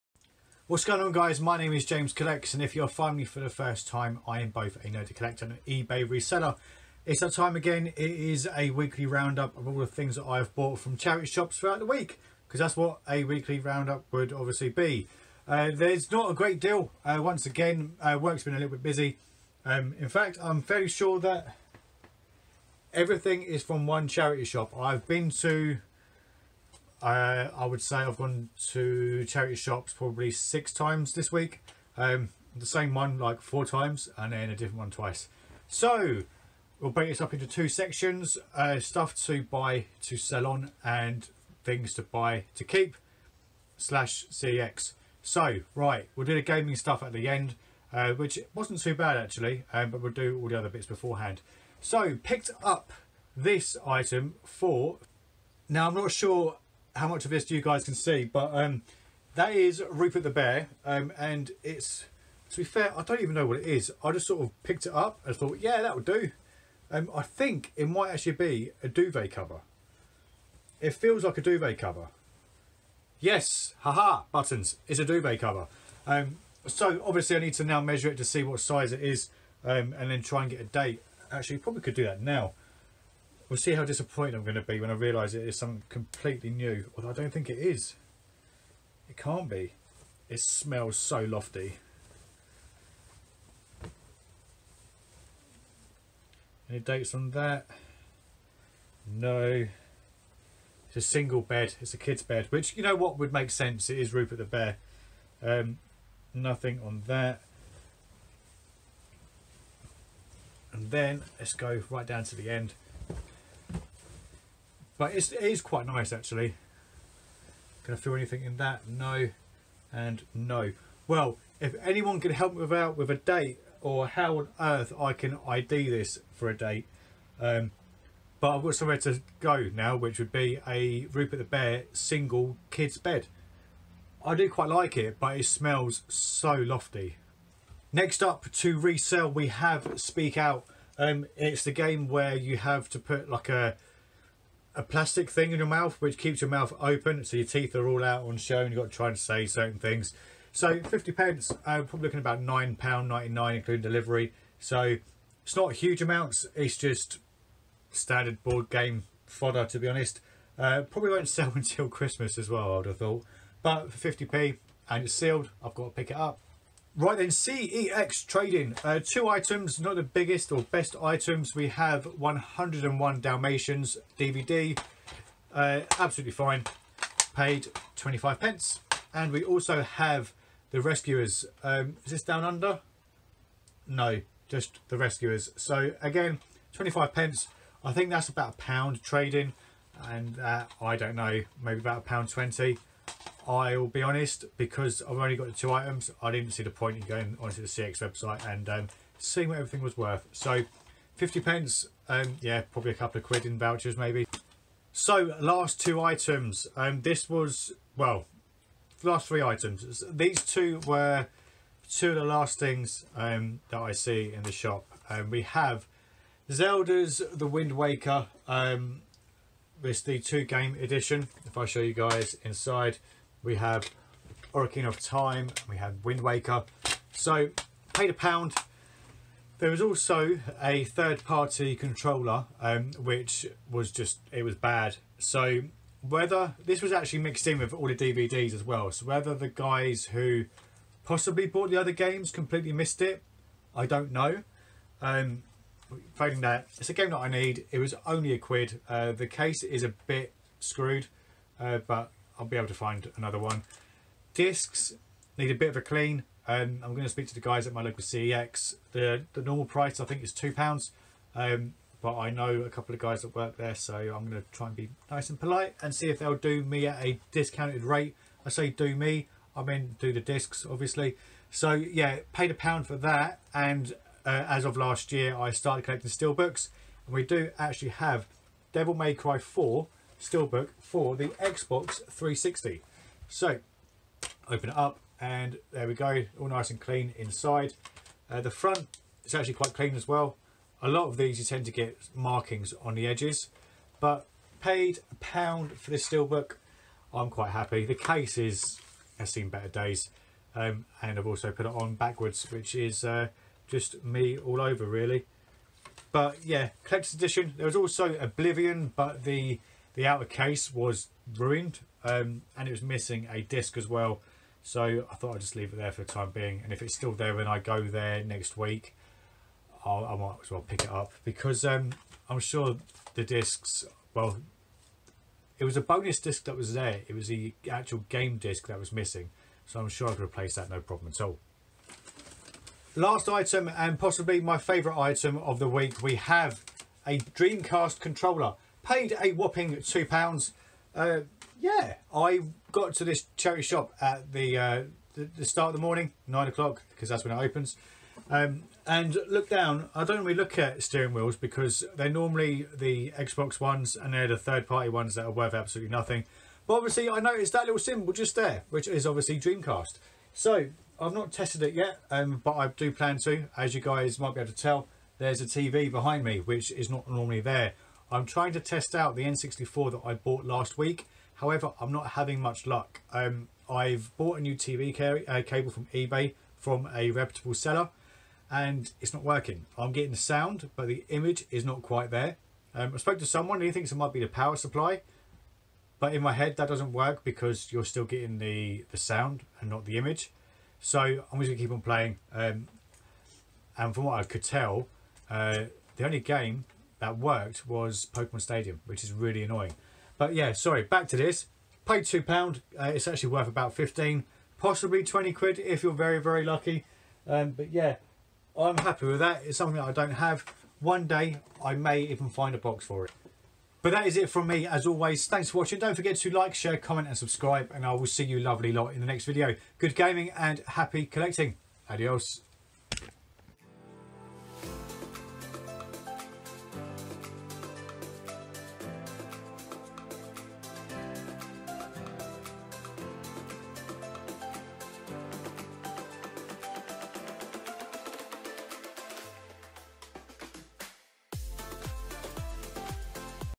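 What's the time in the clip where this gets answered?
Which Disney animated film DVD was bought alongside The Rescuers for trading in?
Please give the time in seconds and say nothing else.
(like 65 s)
172 s.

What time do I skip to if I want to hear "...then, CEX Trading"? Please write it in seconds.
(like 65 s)
167 s.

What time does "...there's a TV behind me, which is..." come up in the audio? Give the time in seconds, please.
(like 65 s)
365 s.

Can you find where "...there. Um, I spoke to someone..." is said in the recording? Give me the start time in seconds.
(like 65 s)
382 s.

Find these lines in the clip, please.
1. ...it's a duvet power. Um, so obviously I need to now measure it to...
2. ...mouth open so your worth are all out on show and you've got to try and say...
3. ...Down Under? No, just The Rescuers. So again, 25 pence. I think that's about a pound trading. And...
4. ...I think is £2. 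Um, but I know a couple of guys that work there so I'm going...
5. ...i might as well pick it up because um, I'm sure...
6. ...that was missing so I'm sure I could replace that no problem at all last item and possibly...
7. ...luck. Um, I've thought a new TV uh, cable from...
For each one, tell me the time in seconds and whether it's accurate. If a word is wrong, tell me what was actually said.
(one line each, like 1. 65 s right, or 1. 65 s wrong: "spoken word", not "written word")
1. 74 s wrong: "cover", not "power"
2. 146 s wrong: "teeth", not "worth"
3. 182 s right
4. 259 s right
5. 320 s right
6. 328 s right
7. 372 s wrong: "bought", not "thought".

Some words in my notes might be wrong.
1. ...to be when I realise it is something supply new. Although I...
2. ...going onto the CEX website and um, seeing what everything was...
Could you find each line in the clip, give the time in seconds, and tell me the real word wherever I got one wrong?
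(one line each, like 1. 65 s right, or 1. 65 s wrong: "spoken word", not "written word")
1. 84 s wrong: "completely", not "supply"
2. 197 s right.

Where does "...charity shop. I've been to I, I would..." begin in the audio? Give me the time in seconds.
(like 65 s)
24 s.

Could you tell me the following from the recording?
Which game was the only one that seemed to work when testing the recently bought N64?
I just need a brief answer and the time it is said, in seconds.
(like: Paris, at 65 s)
Pokemon Stadium, at 398 s.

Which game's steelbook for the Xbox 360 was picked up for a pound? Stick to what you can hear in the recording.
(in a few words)
Devil May Cry 4.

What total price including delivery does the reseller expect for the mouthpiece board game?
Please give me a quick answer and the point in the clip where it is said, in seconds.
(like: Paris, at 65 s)
£9.99, at 152 s.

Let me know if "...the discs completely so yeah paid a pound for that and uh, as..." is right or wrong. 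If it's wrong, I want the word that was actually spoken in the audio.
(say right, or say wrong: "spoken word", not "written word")
wrong: "obviously", not "completely".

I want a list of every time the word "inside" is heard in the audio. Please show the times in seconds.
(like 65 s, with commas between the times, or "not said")
222 s, 287 s.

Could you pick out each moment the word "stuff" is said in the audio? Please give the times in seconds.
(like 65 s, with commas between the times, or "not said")
38 s, 46 s.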